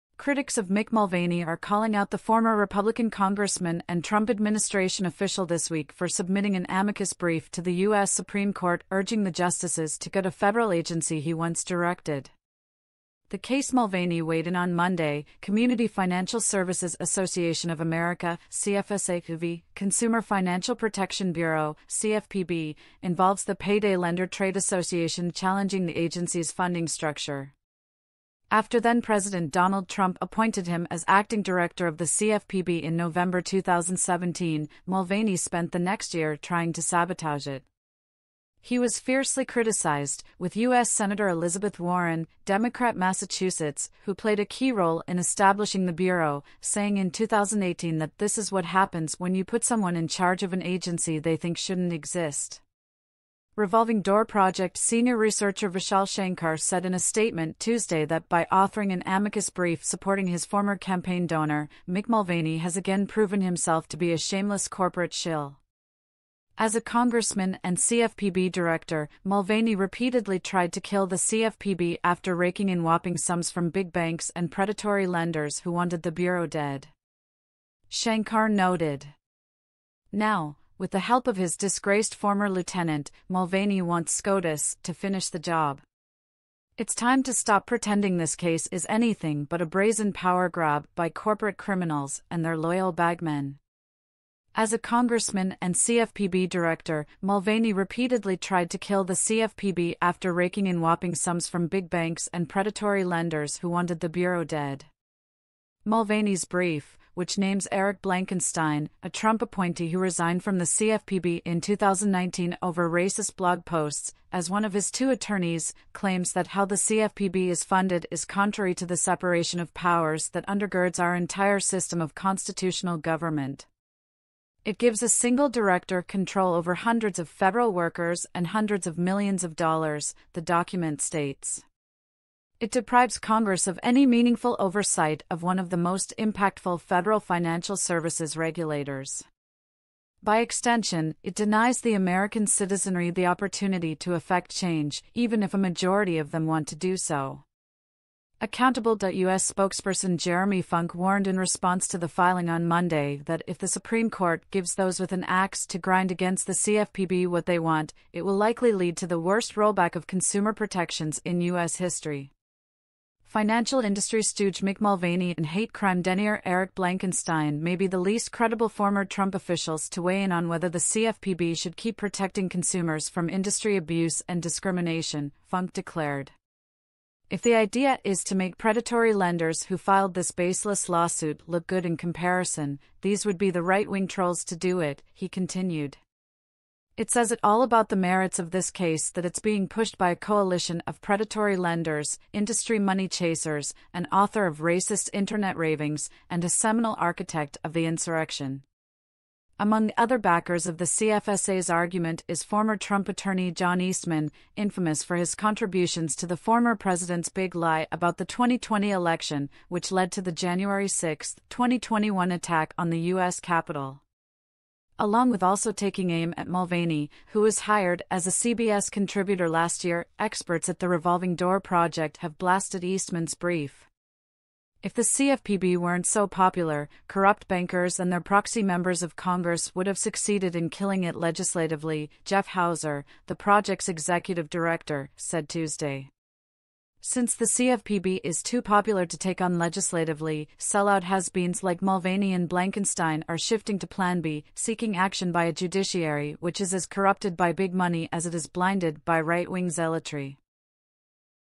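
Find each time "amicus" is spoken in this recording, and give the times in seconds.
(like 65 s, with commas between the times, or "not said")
6 s, 59 s.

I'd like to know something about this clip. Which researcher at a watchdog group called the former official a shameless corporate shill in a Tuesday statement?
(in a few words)
Vishal Shankar.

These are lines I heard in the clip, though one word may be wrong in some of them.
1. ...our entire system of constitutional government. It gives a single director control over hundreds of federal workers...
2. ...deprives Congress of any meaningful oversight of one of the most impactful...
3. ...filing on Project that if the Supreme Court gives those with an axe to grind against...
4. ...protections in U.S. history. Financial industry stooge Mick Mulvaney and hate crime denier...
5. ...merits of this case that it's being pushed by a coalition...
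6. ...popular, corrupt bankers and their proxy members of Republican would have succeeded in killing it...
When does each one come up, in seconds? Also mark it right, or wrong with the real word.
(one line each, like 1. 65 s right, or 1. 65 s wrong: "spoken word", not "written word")
1. 120 s right
2. 132 s right
3. 152 s wrong: "Monday", not "Project"
4. 160 s right
5. 187 s right
6. 226 s wrong: "Congress", not "Republican".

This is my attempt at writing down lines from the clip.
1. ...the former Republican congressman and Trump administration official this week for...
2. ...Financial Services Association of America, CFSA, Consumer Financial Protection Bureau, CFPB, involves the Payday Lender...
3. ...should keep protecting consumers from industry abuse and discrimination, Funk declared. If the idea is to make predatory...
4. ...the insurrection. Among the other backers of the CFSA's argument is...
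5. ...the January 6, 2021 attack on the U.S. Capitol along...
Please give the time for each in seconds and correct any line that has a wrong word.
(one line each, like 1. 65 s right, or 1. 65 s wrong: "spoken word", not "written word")
1. 2 s right
2. 15 s right
3. 171 s right
4. 197 s right
5. 210 s right.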